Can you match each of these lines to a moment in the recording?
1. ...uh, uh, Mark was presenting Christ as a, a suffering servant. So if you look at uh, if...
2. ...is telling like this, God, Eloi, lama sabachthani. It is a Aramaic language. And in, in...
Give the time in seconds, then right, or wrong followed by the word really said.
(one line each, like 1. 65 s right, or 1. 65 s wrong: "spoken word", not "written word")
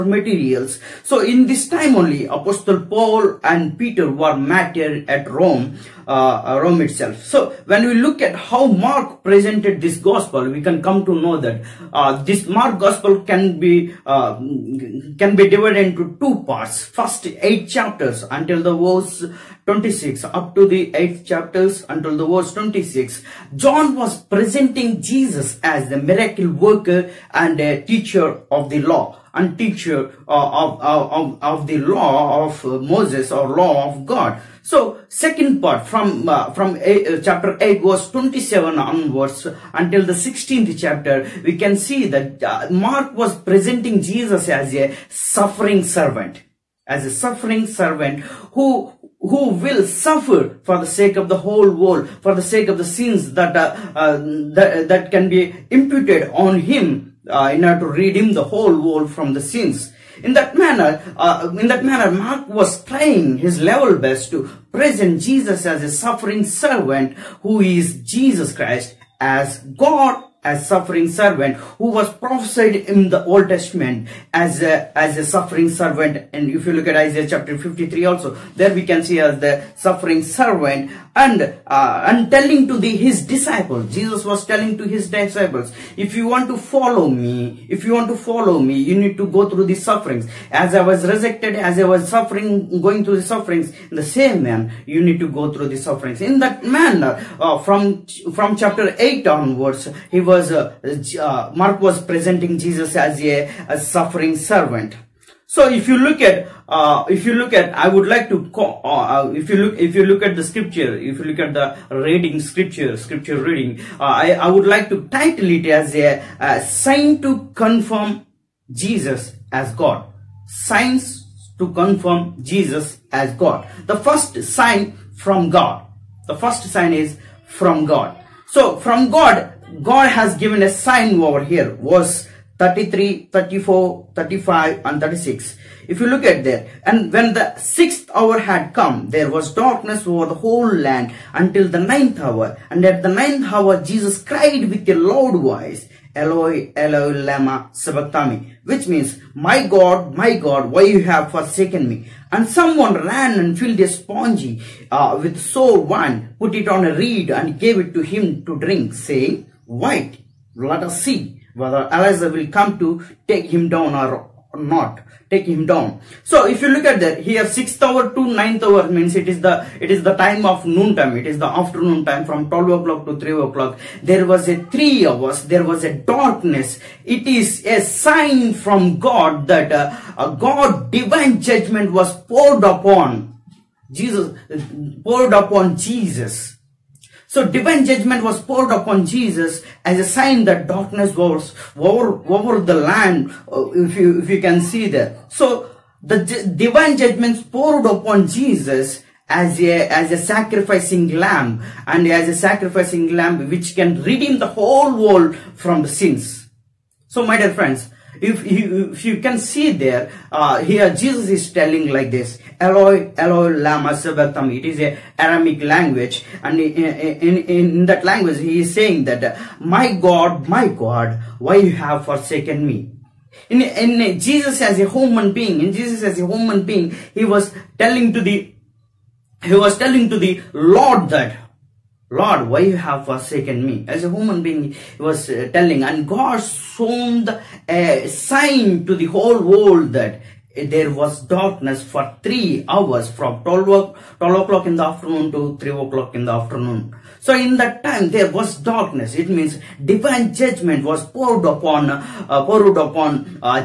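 1. 100 s wrong: "Jesus", not "Christ"
2. 211 s wrong: "Eloi", not "God".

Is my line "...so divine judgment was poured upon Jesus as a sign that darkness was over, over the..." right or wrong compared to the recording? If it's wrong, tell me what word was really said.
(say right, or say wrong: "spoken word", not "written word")
right.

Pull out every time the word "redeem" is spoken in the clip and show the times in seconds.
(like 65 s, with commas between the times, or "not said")
57 s, 204 s.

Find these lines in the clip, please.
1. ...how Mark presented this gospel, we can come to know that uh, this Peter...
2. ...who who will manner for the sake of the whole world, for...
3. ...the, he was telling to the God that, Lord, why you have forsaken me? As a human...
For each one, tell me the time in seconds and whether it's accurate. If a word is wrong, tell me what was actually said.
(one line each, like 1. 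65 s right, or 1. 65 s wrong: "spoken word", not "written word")
1. 8 s wrong: "Mark", not "Peter"
2. 48 s wrong: "suffer", not "manner"
3. 228 s wrong: "Lord", not "God".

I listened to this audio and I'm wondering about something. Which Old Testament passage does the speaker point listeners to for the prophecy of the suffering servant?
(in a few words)
Isaiah chapter 53.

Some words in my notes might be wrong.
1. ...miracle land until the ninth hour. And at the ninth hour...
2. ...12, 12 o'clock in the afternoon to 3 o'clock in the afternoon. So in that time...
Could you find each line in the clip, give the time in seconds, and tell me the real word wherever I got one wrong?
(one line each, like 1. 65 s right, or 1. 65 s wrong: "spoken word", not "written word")
1. 140 s wrong: "whole", not "miracle"
2. 243 s right.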